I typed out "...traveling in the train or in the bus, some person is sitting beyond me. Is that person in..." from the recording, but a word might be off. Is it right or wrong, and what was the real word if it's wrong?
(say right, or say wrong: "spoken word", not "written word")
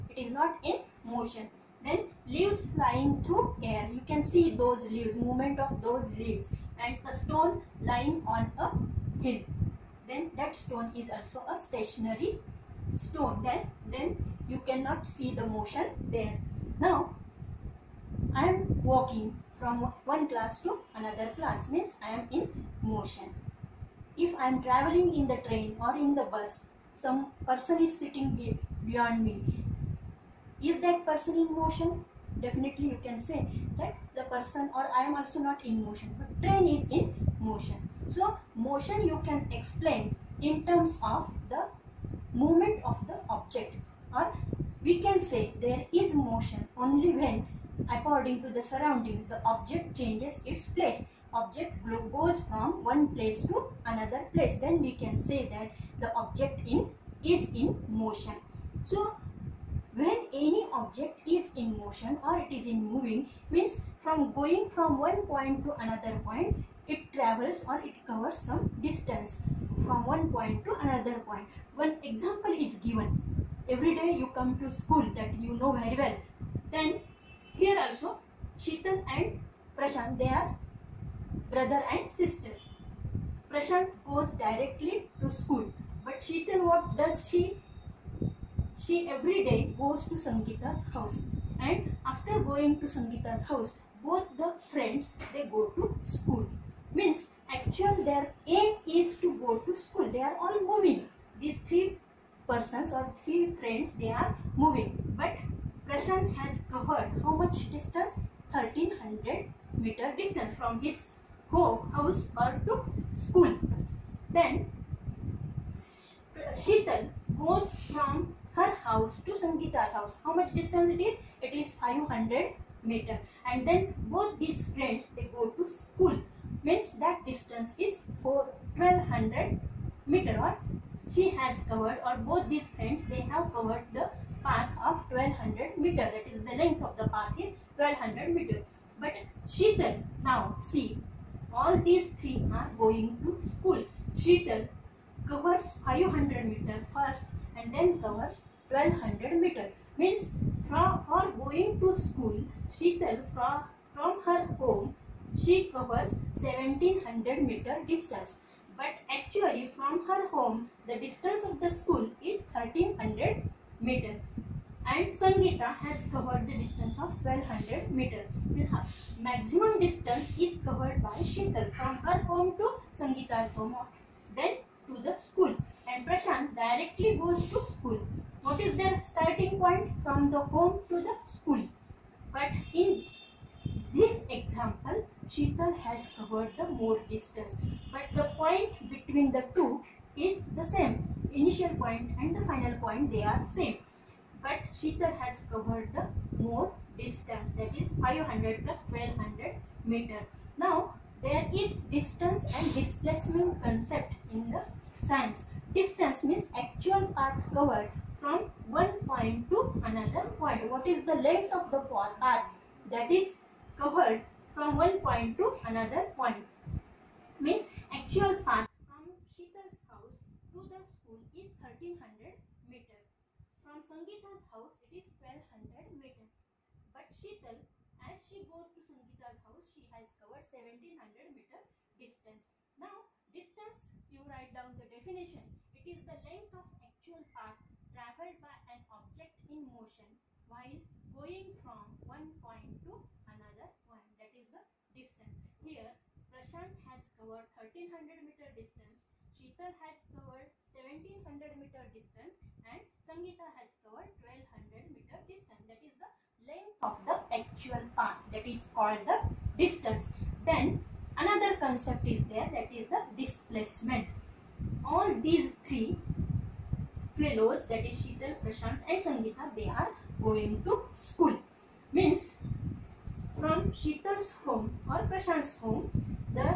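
right.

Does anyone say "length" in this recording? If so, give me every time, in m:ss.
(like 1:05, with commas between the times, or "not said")
2:16, 3:31, 3:56, 4:16.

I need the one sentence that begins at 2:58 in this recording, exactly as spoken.
What is their starting point from the home to the school?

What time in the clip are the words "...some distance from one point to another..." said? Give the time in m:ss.
1:08.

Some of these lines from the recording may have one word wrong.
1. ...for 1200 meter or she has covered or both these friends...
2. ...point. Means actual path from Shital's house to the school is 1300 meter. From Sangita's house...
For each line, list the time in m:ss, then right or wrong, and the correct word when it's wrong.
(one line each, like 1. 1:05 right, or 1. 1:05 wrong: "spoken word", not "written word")
1. 2:08 right
2. 3:36 right.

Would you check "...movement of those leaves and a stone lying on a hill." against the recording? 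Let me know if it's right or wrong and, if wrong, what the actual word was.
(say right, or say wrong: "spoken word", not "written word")
right.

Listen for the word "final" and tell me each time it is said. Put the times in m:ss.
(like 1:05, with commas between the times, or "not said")
3:12.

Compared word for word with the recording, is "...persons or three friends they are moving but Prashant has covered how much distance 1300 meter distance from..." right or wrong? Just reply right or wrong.
right.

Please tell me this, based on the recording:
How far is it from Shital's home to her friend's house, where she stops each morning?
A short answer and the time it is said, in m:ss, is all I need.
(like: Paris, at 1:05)
500 meters, at 2:01.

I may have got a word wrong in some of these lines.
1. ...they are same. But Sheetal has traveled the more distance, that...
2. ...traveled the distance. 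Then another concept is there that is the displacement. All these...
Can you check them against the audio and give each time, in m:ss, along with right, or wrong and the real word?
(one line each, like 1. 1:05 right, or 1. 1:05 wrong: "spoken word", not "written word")
1. 3:13 wrong: "covered", not "traveled"
2. 4:18 wrong: "called", not "traveled".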